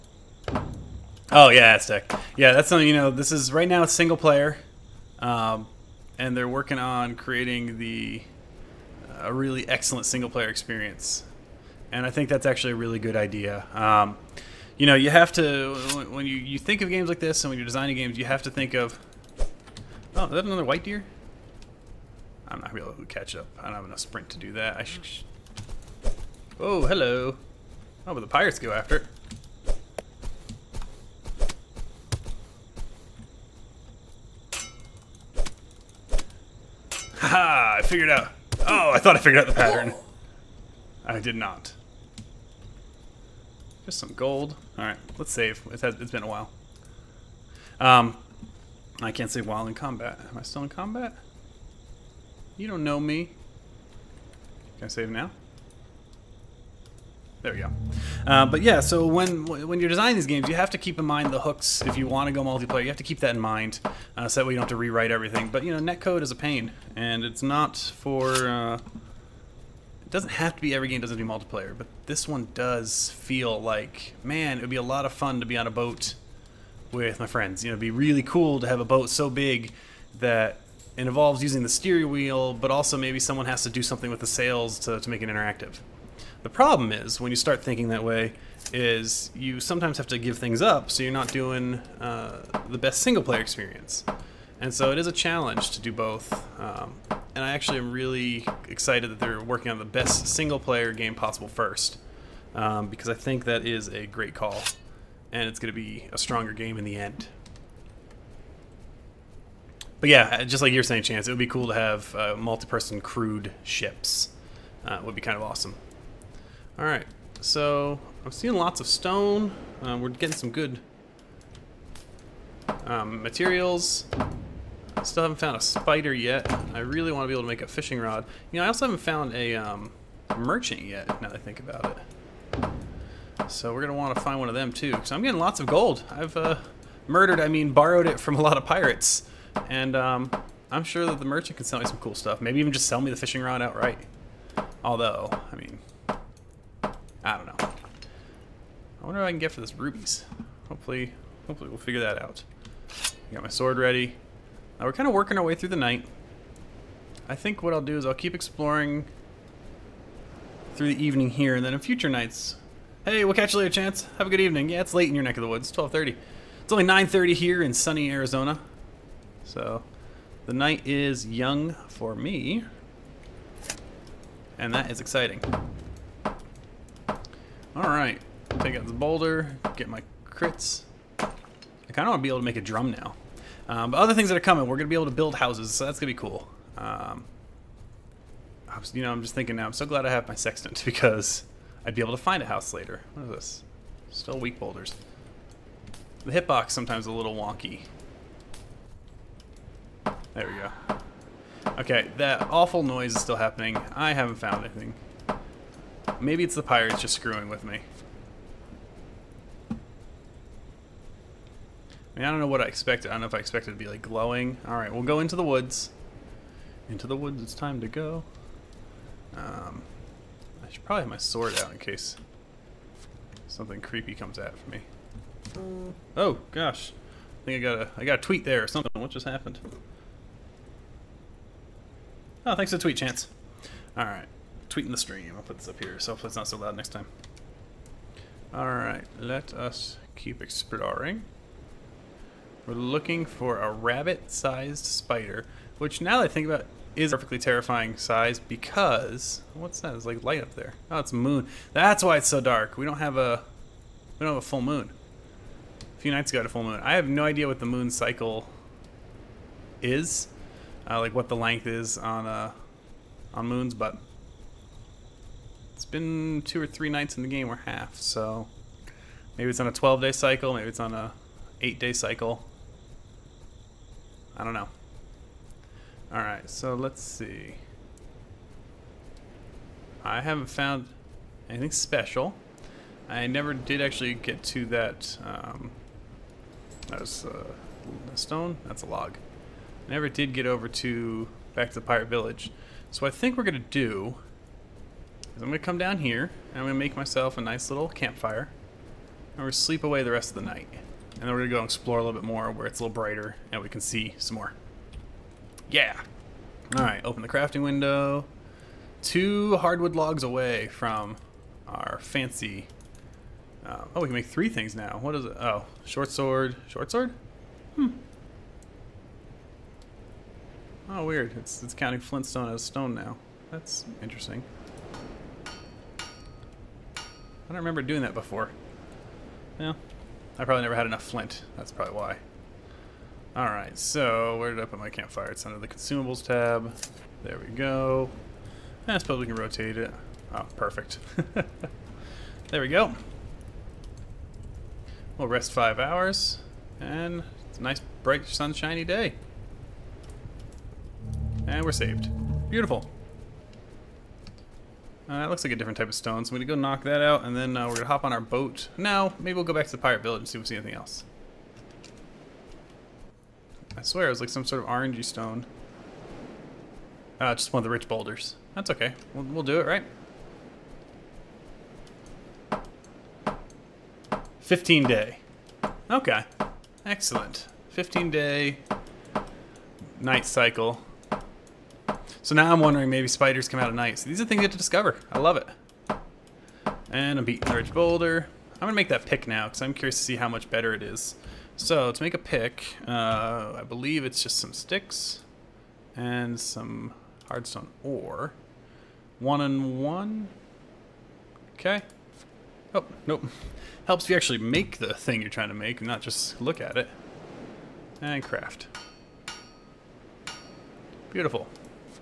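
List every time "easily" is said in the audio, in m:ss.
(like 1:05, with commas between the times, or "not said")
not said.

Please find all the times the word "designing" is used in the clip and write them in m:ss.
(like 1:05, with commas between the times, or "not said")
0:17, 0:59.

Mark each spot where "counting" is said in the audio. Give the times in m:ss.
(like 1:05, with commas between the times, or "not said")
5:21.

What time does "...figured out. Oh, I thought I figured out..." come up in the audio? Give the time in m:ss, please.
0:37.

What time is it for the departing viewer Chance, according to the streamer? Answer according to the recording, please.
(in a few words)
12:30.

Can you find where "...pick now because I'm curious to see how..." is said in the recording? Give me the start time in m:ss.
6:29.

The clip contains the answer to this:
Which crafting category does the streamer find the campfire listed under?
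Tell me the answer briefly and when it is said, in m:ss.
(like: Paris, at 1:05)
consumables, at 5:35.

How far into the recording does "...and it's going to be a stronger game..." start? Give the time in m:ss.
1:45.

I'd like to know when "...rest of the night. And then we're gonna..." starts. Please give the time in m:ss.
5:00.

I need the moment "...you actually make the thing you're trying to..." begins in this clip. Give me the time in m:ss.
6:44.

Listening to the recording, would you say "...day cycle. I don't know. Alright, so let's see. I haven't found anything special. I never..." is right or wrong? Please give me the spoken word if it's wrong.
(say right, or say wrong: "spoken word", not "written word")
right.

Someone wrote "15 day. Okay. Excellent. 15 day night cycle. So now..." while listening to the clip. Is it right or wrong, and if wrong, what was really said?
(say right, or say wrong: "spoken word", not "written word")
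right.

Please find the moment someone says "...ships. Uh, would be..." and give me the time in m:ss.
1:53.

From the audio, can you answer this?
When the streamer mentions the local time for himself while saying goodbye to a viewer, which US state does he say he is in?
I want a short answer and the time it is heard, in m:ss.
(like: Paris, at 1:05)
Arizona, at 2:47.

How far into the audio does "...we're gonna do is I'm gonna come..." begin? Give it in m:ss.
4:53.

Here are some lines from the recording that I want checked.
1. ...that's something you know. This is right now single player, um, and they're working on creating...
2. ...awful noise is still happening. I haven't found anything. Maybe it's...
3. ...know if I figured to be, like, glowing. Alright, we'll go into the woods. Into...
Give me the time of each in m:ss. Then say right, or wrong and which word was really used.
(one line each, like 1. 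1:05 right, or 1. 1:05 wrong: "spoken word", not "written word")
1. 0:02 right
2. 3:22 right
3. 3:33 wrong: "expected", not "figured".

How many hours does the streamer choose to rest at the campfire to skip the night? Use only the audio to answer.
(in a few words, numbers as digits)
5.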